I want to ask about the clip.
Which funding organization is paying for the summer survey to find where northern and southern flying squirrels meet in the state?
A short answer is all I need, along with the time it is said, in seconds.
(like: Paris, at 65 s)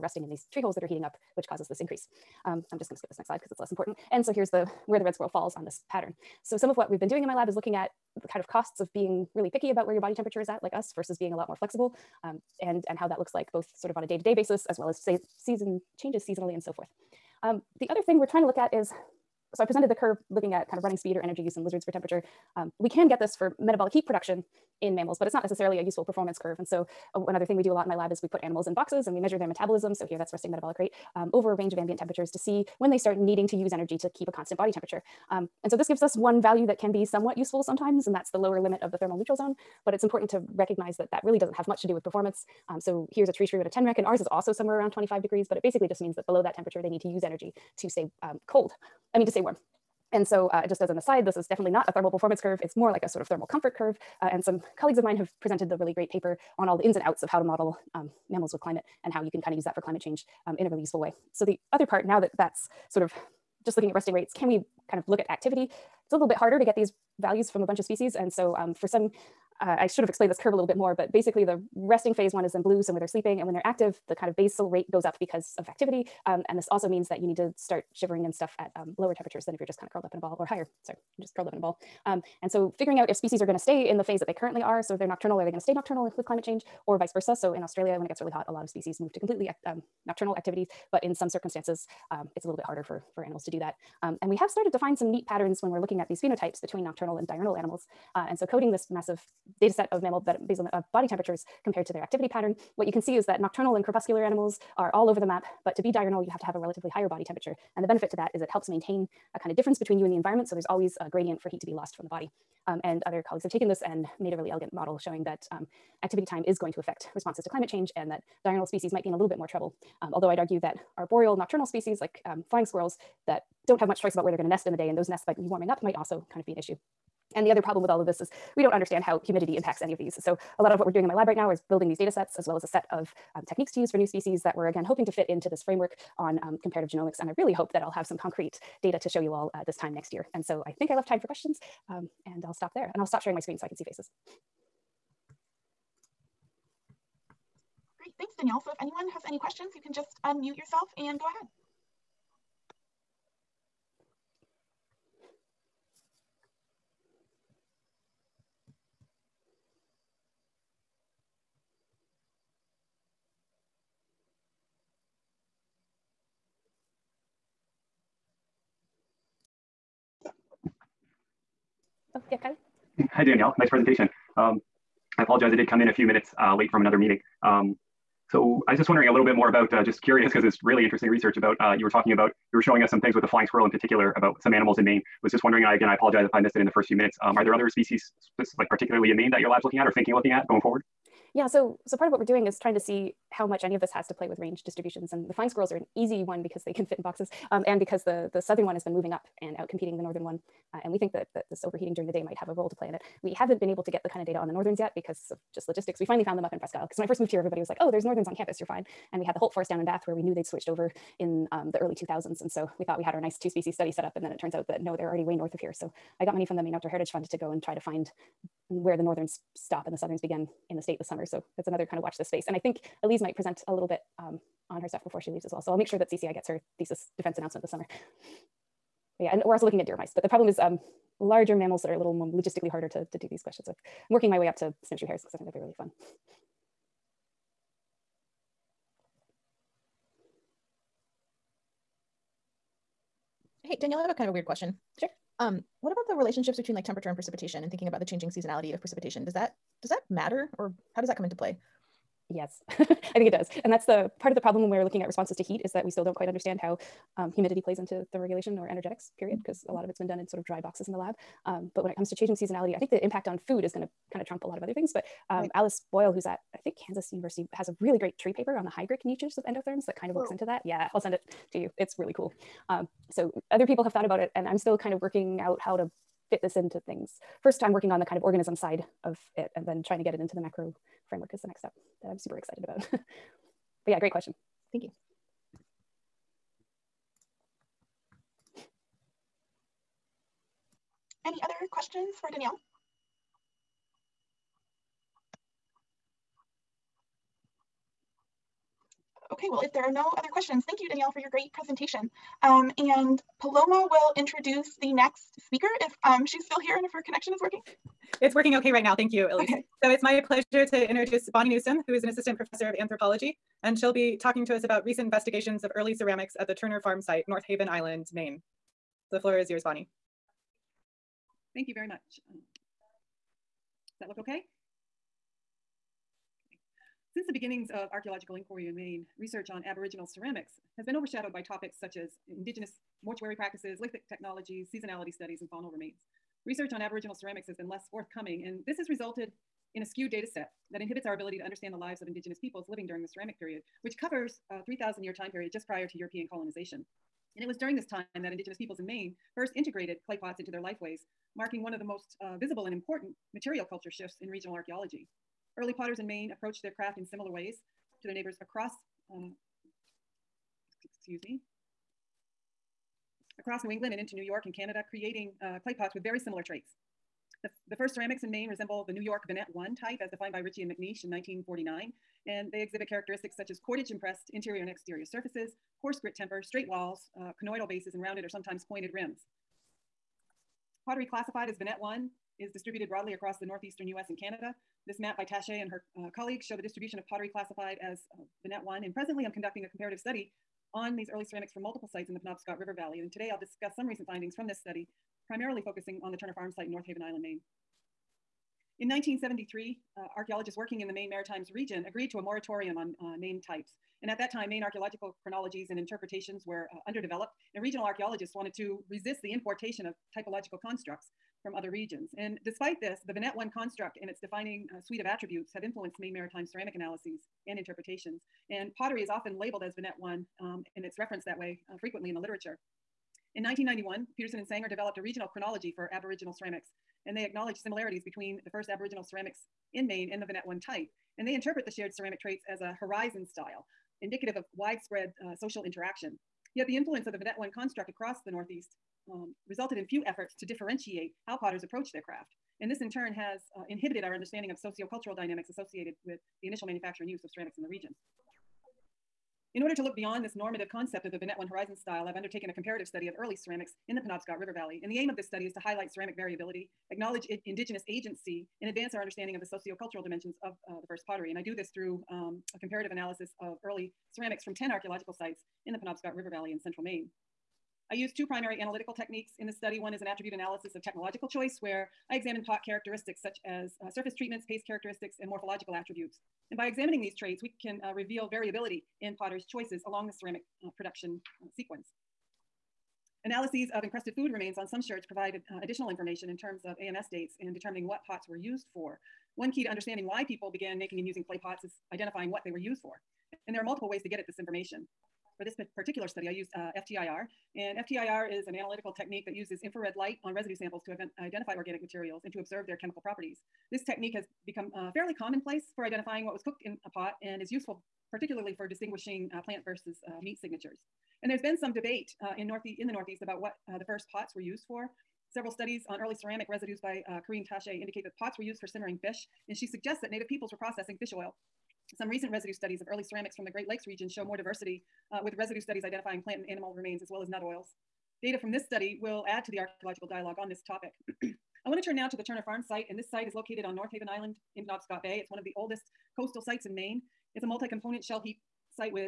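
Maine Outdoor Heritage Fund, at 216 s.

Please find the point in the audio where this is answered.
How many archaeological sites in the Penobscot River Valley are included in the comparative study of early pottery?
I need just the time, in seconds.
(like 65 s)
464 s.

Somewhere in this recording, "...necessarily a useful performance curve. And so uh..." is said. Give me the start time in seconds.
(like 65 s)
25 s.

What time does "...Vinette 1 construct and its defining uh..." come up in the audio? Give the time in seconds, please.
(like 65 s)
413 s.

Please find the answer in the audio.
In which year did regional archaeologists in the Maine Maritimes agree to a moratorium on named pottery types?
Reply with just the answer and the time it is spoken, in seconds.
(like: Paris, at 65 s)
1973, at 398 s.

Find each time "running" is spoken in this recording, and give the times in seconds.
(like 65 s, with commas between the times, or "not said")
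20 s.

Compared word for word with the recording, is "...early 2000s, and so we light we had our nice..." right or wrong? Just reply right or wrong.
wrong.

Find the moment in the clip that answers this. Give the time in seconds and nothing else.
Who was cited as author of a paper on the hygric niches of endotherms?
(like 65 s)
265 s.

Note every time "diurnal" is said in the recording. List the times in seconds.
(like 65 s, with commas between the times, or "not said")
97 s, 105 s, 118 s.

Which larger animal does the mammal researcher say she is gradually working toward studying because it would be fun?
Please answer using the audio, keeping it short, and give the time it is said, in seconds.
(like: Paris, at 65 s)
Snowshoe hares, at 234 s.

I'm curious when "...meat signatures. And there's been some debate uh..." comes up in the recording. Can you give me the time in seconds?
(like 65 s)
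510 s.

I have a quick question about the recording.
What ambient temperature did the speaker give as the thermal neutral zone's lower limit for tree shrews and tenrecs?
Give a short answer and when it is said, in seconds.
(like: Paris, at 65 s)
25 degrees, at 44 s.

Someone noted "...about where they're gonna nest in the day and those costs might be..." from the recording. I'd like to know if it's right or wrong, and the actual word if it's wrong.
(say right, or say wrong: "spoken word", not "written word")
wrong: "nests", not "costs".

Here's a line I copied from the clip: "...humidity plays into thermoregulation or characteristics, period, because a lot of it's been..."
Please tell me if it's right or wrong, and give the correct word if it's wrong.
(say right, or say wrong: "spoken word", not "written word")
wrong: "energetics", not "characteristics".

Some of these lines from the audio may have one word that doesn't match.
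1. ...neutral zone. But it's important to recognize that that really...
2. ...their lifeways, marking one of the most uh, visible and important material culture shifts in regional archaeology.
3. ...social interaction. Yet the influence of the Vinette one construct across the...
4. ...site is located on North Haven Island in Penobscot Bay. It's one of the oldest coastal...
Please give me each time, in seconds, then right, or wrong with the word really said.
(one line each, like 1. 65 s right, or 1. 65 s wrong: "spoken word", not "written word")
1. 39 s right
2. 350 s right
3. 435 s right
4. 533 s right.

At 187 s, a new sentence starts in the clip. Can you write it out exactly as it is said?
Um, are there other species that's like particularly in Maine that your lab's looking at or thinking looking at going forward?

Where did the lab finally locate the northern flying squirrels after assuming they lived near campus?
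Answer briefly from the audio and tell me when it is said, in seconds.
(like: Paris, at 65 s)
Presque Isle, at 206 s.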